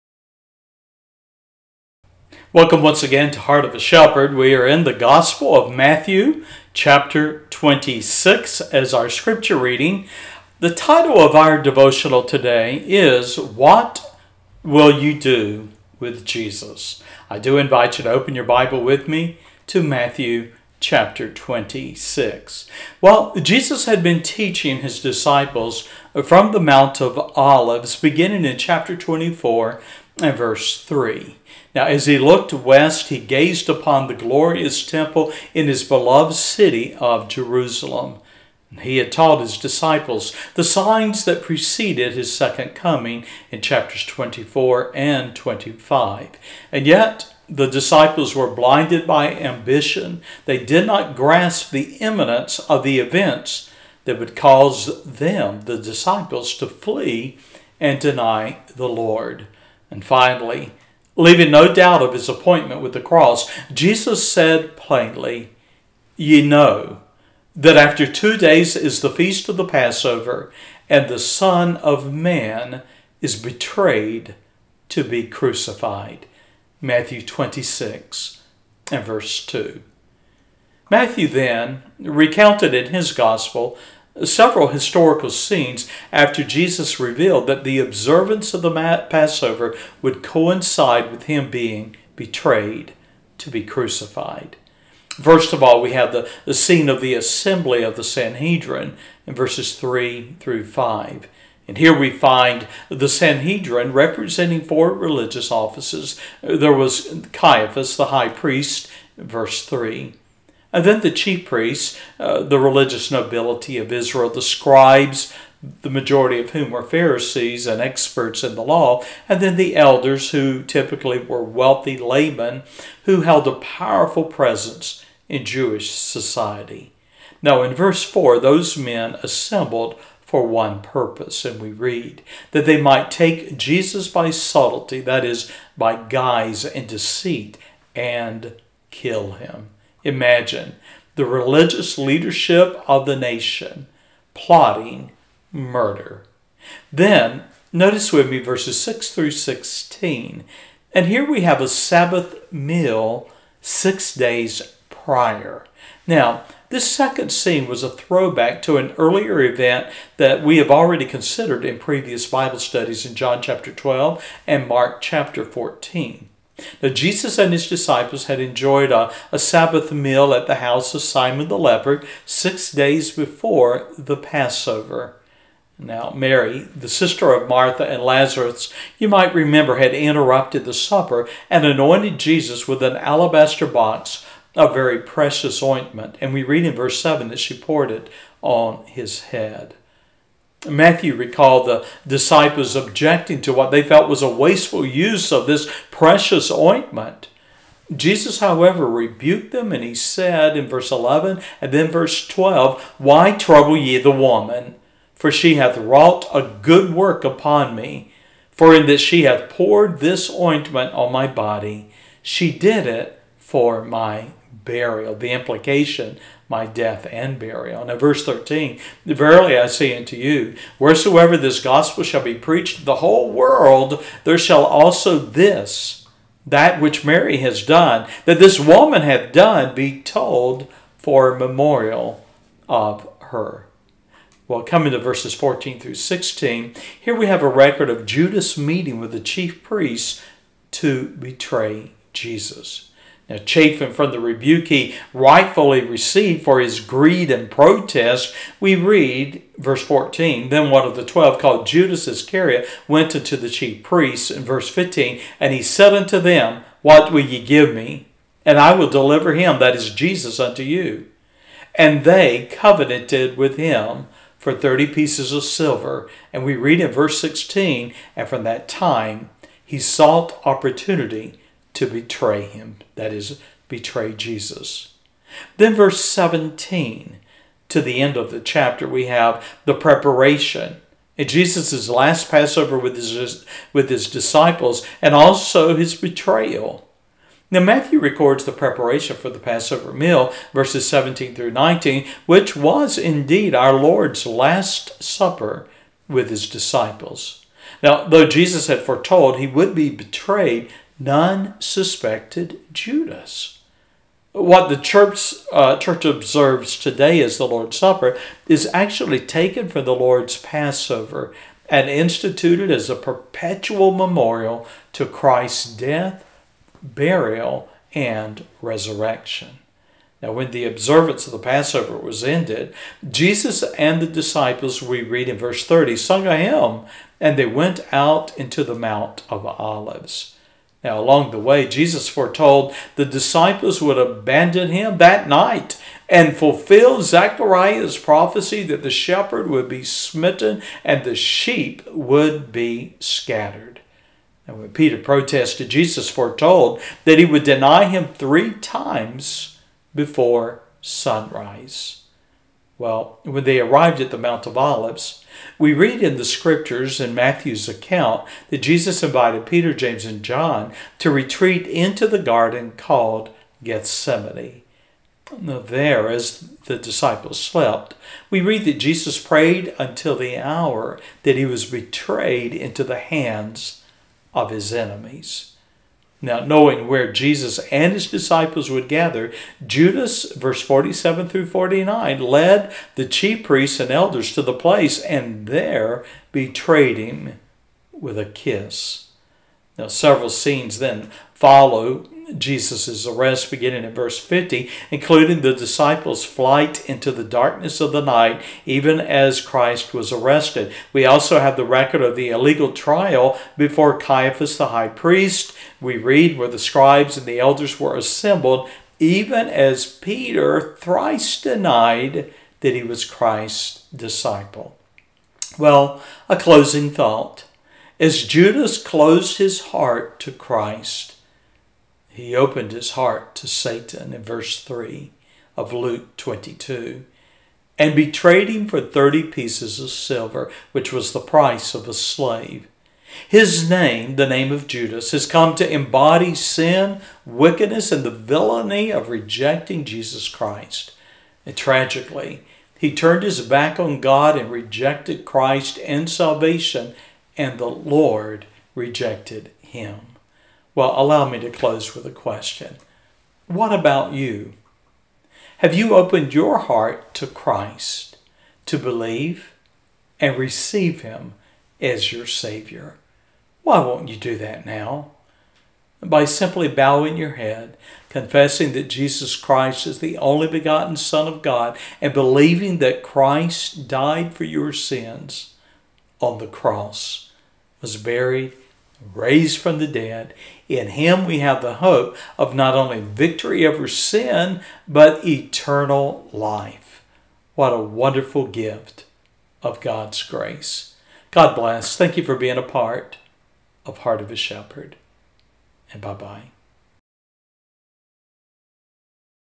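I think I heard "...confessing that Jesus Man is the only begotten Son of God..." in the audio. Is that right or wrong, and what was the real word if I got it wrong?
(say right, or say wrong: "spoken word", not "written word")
wrong: "Christ", not "Man".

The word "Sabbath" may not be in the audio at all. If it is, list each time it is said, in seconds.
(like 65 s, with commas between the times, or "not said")
151 s, 169 s.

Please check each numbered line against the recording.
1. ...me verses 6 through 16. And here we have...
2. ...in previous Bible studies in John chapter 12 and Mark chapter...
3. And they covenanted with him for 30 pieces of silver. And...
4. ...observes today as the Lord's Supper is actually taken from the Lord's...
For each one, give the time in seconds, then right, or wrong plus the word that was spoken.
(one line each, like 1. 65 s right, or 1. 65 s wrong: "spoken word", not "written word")
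1. 148 s right
2. 161 s right
3. 261 s right
4. 306 s right.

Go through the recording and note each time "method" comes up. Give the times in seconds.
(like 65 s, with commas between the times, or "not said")
not said.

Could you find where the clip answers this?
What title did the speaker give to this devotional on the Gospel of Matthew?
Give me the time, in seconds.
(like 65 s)
13 s.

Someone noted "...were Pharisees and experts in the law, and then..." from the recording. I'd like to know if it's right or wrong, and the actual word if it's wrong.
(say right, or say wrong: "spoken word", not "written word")
right.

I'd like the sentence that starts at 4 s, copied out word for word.
We are in the Gospel of Matthew, chapter 26, as our scripture reading.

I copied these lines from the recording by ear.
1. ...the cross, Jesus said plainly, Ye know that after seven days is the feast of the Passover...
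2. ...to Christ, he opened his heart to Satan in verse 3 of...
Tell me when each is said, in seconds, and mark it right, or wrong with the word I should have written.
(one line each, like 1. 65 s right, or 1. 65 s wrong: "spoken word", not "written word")
1. 62 s wrong: "two", not "seven"
2. 420 s right.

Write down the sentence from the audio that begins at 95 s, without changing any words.
First of all, we have the, the scene of the assembly of the Sanhedrin in verses 3 through 5.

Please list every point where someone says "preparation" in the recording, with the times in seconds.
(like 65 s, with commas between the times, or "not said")
279 s, 288 s.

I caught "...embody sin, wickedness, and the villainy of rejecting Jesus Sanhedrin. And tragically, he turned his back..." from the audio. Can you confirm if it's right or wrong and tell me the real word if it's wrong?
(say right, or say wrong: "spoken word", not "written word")
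wrong: "Christ", not "Sanhedrin".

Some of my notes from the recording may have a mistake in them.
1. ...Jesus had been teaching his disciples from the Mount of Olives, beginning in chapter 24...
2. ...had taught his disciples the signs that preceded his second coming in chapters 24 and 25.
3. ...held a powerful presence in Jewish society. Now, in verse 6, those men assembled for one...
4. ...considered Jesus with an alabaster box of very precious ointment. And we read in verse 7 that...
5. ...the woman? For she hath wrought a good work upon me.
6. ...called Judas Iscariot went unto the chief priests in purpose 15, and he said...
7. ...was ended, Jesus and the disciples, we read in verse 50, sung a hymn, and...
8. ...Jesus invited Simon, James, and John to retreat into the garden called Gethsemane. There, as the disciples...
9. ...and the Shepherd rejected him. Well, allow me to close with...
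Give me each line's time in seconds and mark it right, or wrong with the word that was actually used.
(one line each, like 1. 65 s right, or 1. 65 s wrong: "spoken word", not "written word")
1. 23 s right
2. 38 s right
3. 123 s wrong: "4", not "6"
4. 181 s wrong: "anointed", not "considered"
5. 203 s right
6. 251 s wrong: "verse", not "purpose"
7. 321 s wrong: "30", not "50"
8. 358 s wrong: "Peter", not "Simon"
9. 447 s wrong: "Lord", not "Shepherd".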